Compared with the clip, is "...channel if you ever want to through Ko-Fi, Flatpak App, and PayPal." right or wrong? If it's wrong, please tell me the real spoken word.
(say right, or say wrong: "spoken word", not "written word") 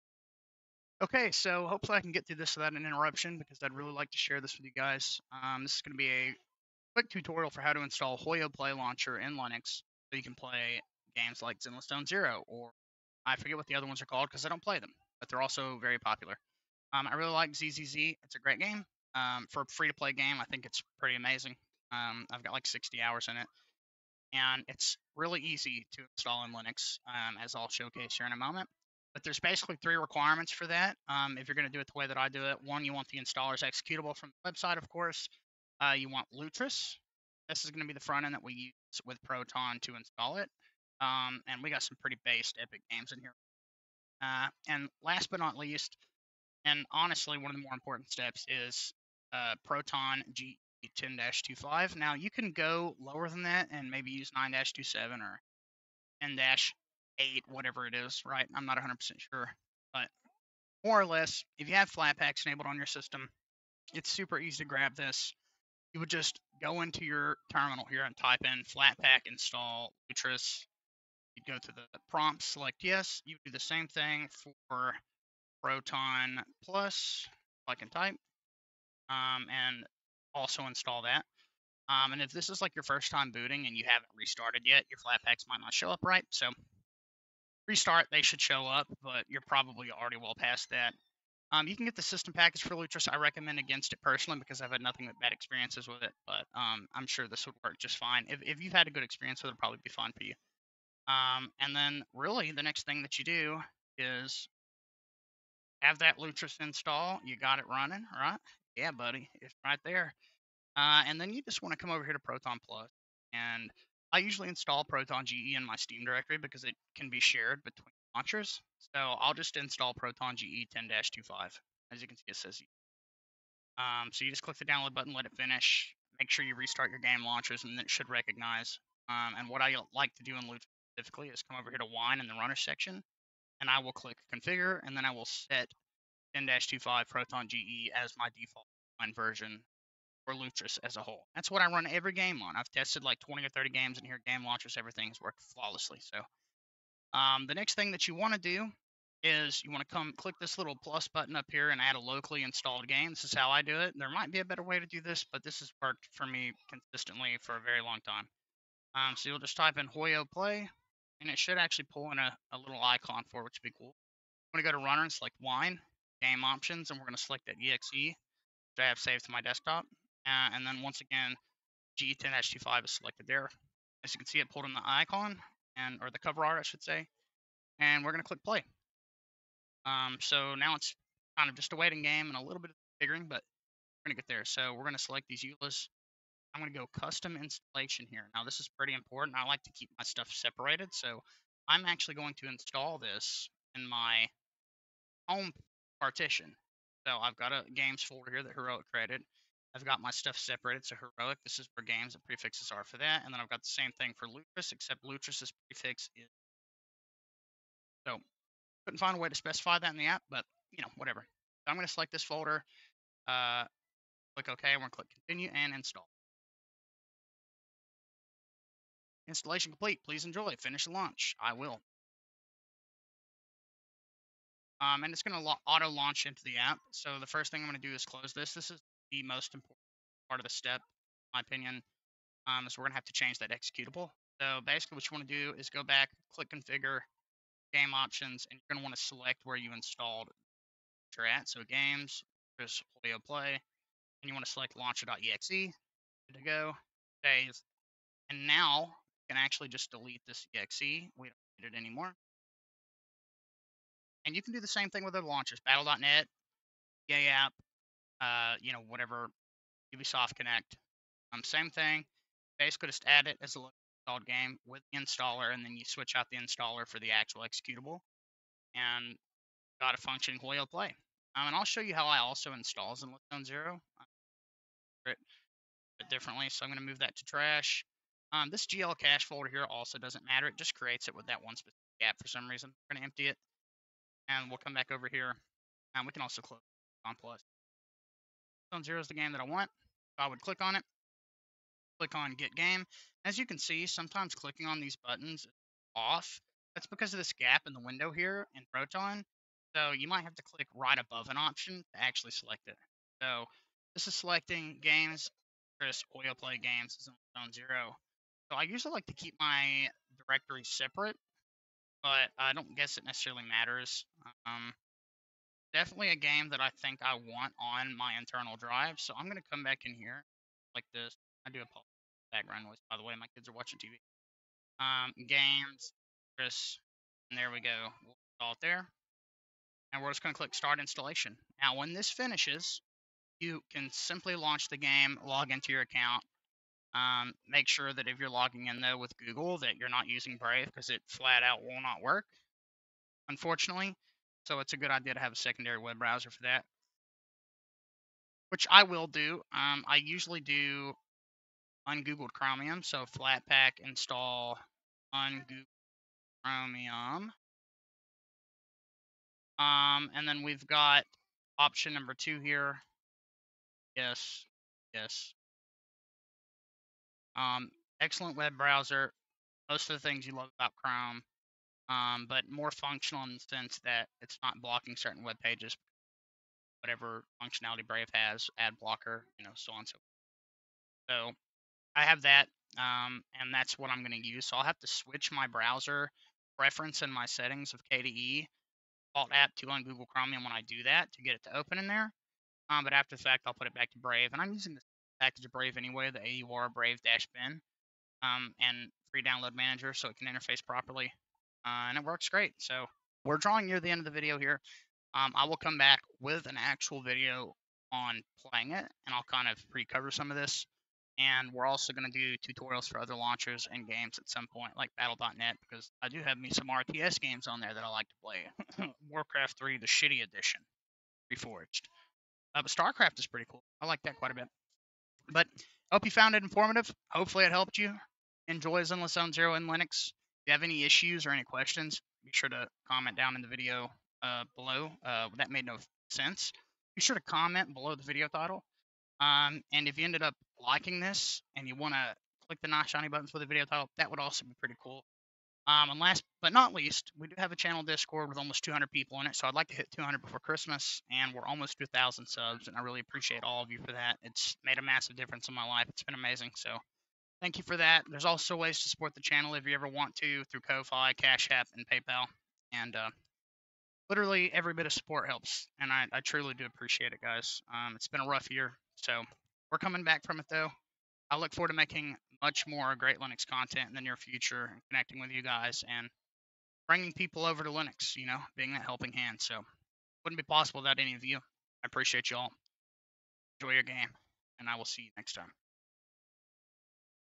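wrong: "Cash", not "Flatpak".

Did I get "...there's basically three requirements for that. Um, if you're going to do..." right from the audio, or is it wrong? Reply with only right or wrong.
right.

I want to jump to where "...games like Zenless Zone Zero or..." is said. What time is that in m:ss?
0:11.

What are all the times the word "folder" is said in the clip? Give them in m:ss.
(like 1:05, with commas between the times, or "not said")
3:18, 3:32, 4:39.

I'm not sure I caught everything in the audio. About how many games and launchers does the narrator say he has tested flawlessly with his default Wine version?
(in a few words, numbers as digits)
20 or 30.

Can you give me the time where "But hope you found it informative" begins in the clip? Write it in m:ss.
7:05.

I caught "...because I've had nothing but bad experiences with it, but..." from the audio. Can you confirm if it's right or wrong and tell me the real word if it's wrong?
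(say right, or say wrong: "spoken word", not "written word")
right.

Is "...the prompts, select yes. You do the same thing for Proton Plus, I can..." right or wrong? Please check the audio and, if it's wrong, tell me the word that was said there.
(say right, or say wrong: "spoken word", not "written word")
right.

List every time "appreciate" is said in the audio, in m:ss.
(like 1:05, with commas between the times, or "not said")
7:32, 7:46, 8:01.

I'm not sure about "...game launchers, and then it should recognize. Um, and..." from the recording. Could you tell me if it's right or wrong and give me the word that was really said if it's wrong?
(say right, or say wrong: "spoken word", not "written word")
right.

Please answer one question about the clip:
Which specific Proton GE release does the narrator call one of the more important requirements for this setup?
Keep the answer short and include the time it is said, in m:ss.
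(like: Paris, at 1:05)
Proton GE 10-25, at 0:49.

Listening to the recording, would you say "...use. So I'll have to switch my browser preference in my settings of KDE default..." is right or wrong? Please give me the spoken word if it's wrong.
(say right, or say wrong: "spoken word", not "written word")
right.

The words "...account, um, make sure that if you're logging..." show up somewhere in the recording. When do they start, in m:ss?
5:35.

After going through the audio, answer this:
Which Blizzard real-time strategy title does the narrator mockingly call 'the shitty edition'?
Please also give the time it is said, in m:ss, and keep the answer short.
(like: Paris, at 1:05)
Warcraft 3 Reforged, at 6:59.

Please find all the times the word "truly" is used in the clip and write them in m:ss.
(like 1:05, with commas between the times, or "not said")
7:46.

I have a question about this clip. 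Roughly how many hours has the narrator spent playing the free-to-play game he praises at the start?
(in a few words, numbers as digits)
60 hours.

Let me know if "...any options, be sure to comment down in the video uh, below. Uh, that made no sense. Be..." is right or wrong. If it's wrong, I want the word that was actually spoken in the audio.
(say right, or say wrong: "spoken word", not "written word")
wrong: "questions", not "options".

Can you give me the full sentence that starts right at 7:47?
Um, it's been a rough year, so we're coming back from it though.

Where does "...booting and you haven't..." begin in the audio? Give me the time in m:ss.
1:23.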